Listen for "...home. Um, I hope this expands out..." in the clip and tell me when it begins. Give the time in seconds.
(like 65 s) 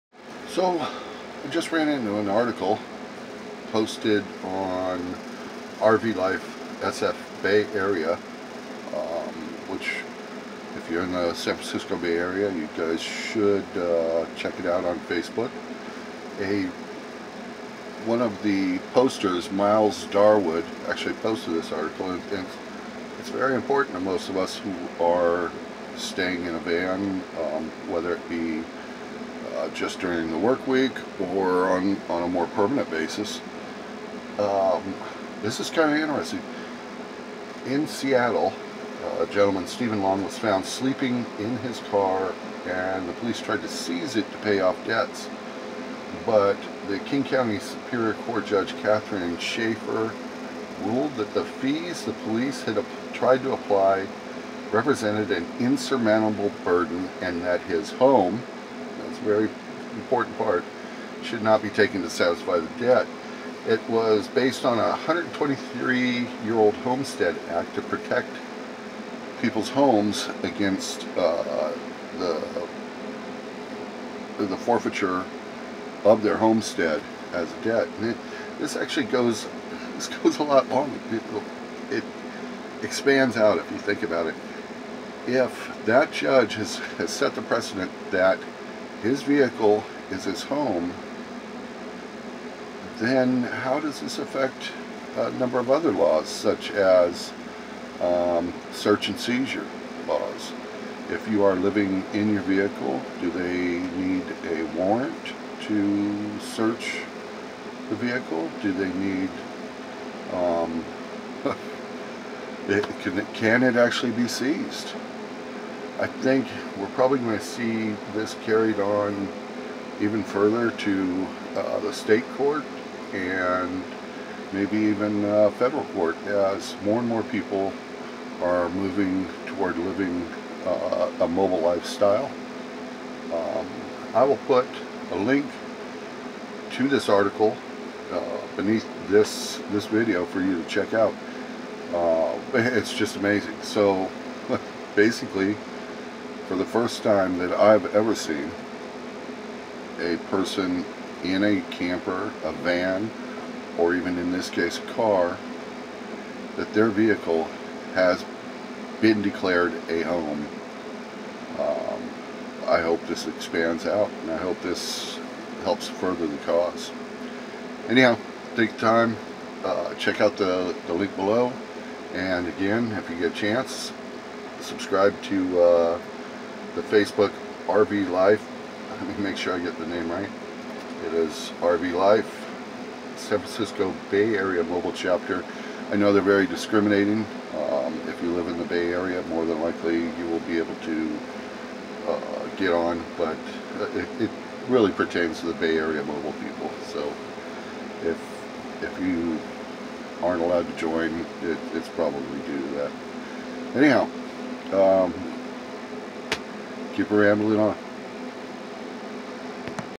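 160 s.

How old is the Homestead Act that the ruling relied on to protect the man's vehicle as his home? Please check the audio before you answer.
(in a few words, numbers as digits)
123 years.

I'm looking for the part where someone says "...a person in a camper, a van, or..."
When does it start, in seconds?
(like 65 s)
150 s.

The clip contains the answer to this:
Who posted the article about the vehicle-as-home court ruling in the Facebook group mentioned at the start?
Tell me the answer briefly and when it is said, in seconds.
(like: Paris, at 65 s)
Miles Darwood, at 19 s.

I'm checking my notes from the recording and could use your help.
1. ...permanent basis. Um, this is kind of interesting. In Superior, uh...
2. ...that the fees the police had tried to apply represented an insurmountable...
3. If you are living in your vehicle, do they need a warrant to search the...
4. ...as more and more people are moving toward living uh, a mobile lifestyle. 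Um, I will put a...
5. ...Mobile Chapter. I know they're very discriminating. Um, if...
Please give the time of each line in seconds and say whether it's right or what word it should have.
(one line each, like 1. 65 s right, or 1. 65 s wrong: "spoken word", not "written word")
1. 32 s wrong: "Seattle", not "Superior"
2. 51 s right
3. 101 s right
4. 126 s right
5. 184 s right.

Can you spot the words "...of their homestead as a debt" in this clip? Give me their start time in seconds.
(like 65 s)
76 s.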